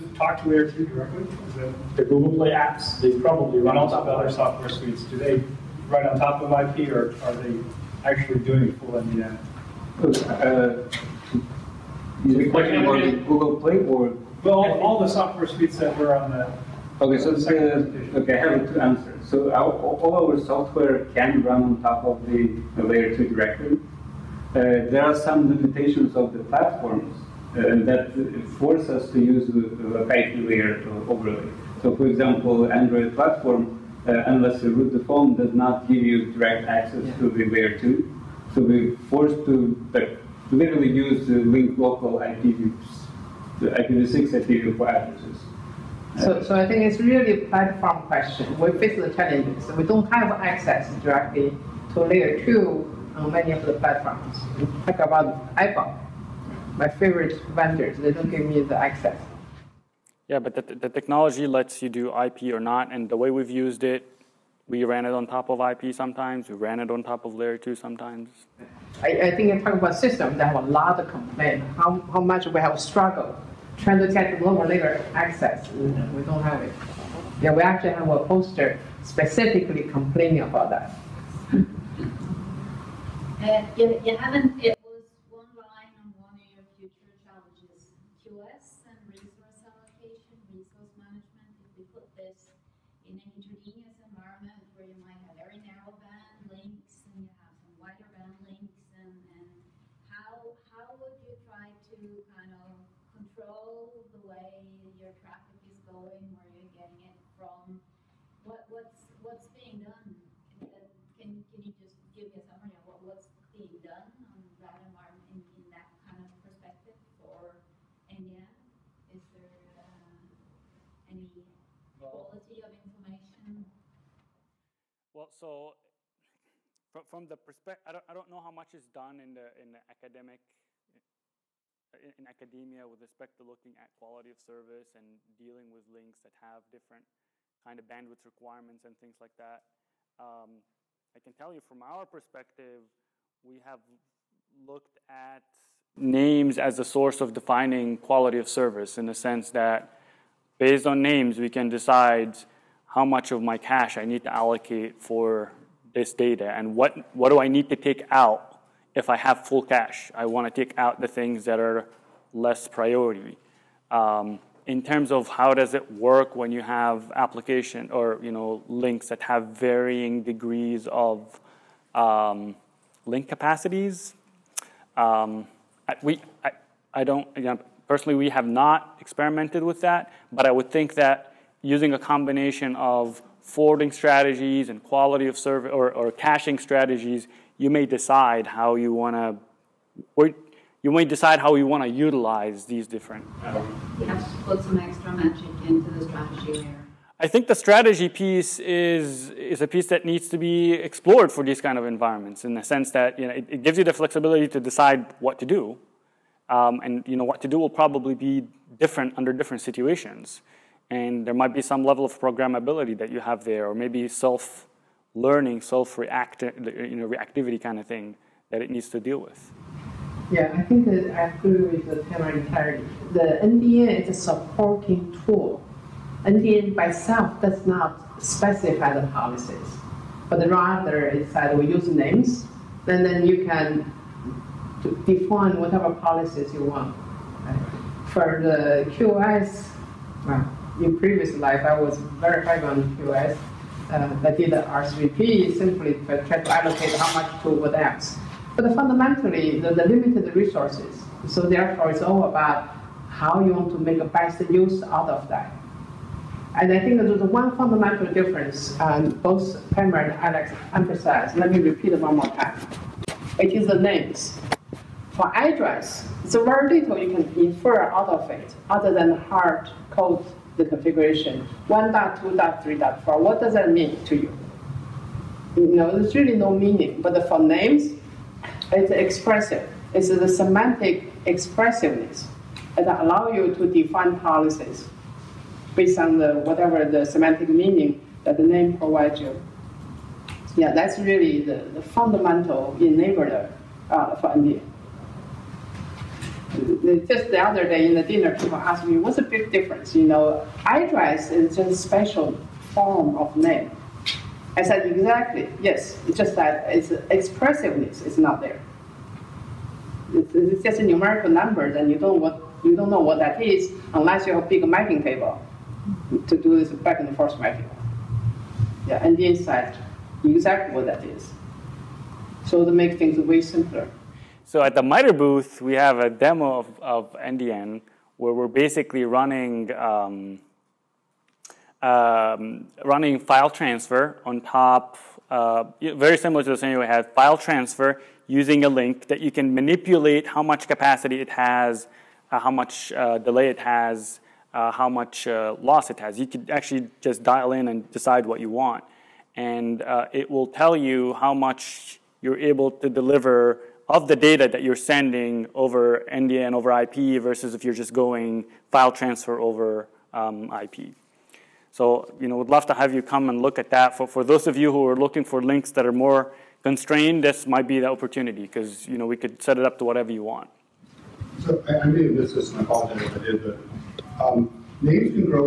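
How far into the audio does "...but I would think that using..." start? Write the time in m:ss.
3:00.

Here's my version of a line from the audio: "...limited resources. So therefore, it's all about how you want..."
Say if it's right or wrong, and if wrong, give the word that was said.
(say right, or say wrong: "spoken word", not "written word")
right.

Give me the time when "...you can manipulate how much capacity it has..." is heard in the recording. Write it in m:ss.
5:39.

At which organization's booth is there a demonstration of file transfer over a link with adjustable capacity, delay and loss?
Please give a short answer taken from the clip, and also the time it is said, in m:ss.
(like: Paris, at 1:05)
MITRE, at 5:24.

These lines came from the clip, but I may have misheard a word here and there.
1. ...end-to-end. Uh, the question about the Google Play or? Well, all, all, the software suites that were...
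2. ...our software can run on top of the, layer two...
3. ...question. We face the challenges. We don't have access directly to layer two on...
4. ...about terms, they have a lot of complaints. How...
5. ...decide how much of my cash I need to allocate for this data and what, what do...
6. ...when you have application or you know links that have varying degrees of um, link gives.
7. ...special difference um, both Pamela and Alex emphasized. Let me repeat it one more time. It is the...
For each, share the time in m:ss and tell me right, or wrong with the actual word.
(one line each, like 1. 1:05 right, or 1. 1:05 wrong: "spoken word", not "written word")
1. 0:08 right
2. 0:20 right
3. 0:48 right
4. 1:09 wrong: "systems", not "terms"
5. 2:31 right
6. 2:46 wrong: "capacities", not "gives"
7. 4:17 wrong: "fundamental", not "special".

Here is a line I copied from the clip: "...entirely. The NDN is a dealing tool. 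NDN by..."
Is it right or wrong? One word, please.
wrong.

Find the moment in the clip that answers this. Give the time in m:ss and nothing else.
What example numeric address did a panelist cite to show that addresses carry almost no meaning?
4:31.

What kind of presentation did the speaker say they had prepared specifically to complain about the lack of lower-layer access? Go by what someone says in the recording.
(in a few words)
a poster.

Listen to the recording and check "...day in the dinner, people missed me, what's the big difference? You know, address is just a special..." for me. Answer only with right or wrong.
wrong.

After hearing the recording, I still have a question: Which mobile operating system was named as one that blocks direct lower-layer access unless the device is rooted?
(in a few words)
Android.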